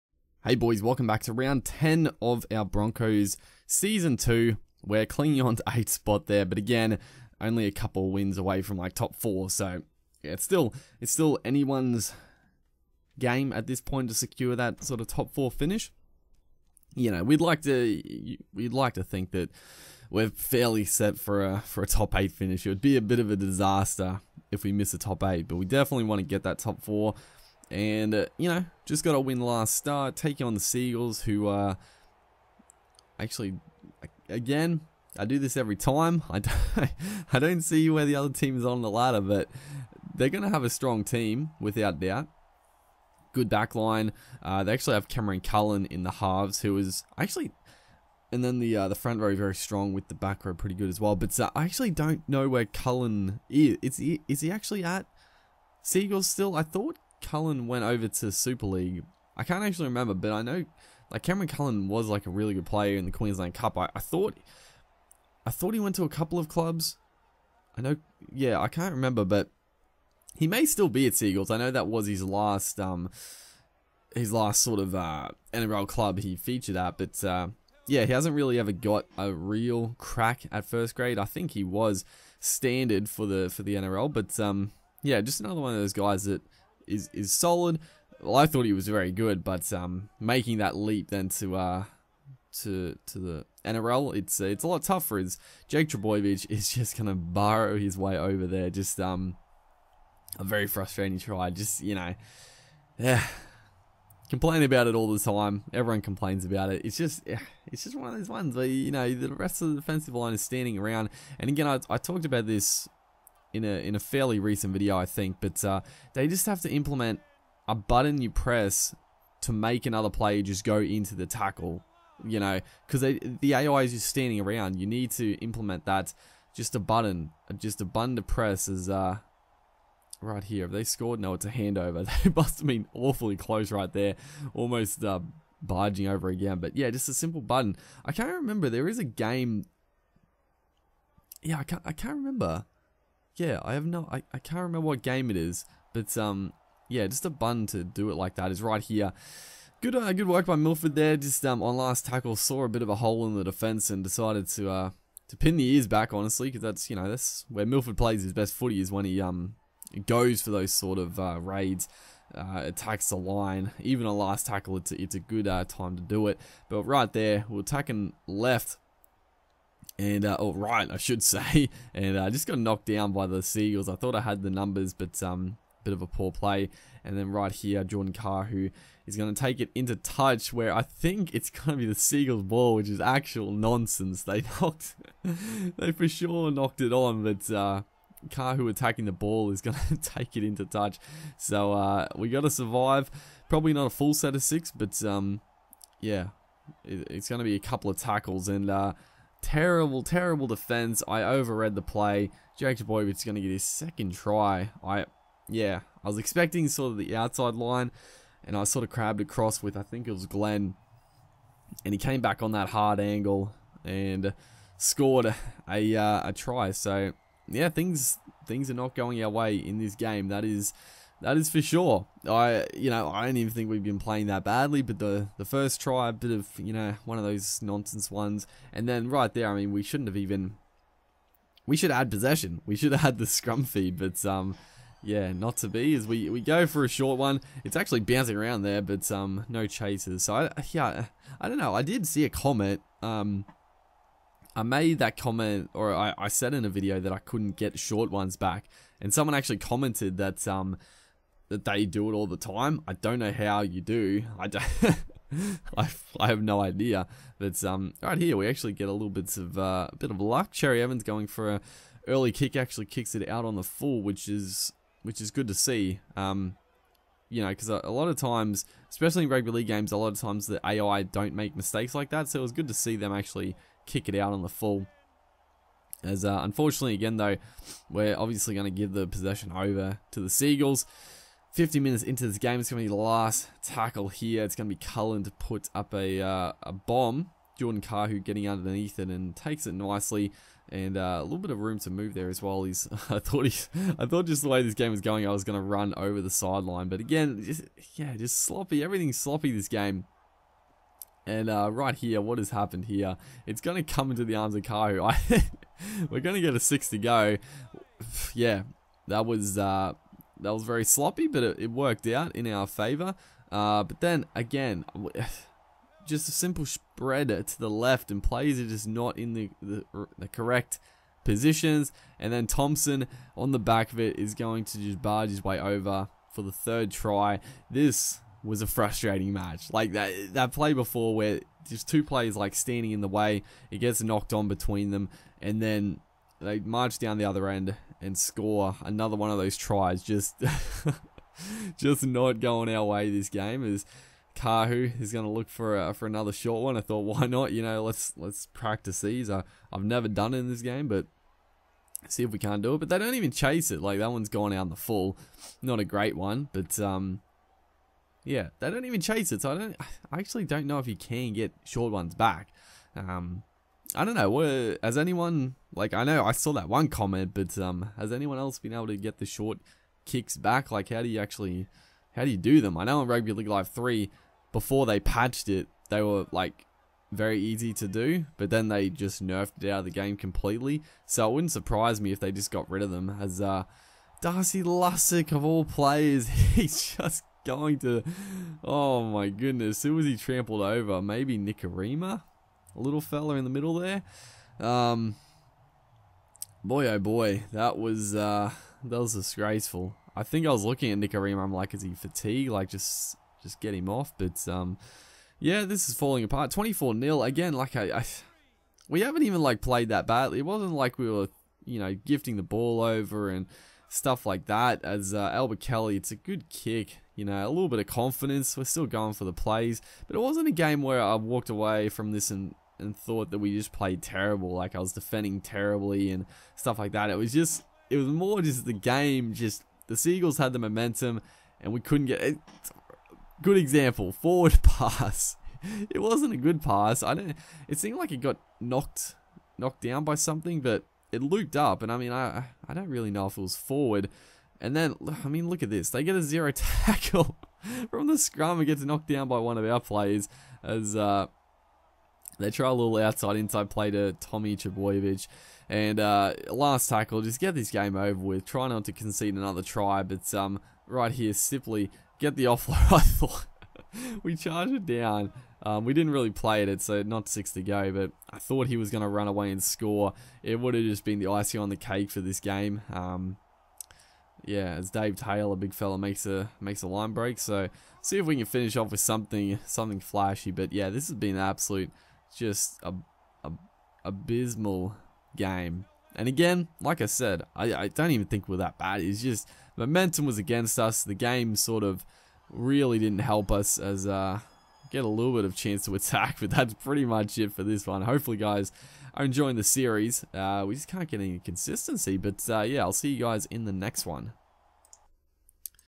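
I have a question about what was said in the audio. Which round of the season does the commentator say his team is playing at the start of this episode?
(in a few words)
Round 10.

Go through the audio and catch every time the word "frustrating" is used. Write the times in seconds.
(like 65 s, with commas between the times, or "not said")
100 s, 328 s.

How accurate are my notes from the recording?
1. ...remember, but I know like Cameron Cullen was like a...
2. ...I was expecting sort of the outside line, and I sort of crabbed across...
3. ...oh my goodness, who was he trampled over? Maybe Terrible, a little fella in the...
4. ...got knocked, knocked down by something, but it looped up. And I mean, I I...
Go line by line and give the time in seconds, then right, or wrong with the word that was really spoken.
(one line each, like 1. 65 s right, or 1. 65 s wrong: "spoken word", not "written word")
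1. 59 s right
2. 206 s right
3. 388 s wrong: "Nikorima", not "Terrible"
4. 438 s right.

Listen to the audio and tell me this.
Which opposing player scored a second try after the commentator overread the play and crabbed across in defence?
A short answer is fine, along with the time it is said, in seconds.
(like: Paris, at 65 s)
Jack Boywood, at 202 s.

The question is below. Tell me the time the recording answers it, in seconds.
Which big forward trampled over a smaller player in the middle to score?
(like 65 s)
384 s.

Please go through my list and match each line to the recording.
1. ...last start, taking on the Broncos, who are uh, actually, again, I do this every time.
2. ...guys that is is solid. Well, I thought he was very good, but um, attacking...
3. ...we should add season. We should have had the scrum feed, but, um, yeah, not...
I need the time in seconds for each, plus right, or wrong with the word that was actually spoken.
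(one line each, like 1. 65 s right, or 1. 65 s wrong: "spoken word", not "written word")
1. 29 s wrong: "Seagulls", not "Broncos"
2. 85 s wrong: "making", not "attacking"
3. 231 s wrong: "possession", not "season".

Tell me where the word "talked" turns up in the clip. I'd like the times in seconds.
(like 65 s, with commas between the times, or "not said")
111 s.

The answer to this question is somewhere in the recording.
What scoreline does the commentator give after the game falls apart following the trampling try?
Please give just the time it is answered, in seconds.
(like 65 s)
406 s.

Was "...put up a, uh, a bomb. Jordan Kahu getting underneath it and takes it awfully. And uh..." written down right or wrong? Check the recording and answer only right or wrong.
wrong.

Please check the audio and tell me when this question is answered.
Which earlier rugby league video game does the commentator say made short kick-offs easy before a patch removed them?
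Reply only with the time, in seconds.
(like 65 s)
373 s.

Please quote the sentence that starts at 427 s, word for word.
It was just, it was more just the game, just the Seagulls had the momentum and we couldn't get it.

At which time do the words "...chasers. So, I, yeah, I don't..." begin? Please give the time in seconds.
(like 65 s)
239 s.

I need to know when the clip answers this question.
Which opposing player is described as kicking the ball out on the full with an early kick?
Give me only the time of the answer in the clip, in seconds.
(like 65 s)
260 s.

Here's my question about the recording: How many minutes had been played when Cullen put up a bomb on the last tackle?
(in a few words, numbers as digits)
50.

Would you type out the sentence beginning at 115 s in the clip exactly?
But uh, they just have to implement a button you press to make another player just go into the tackle.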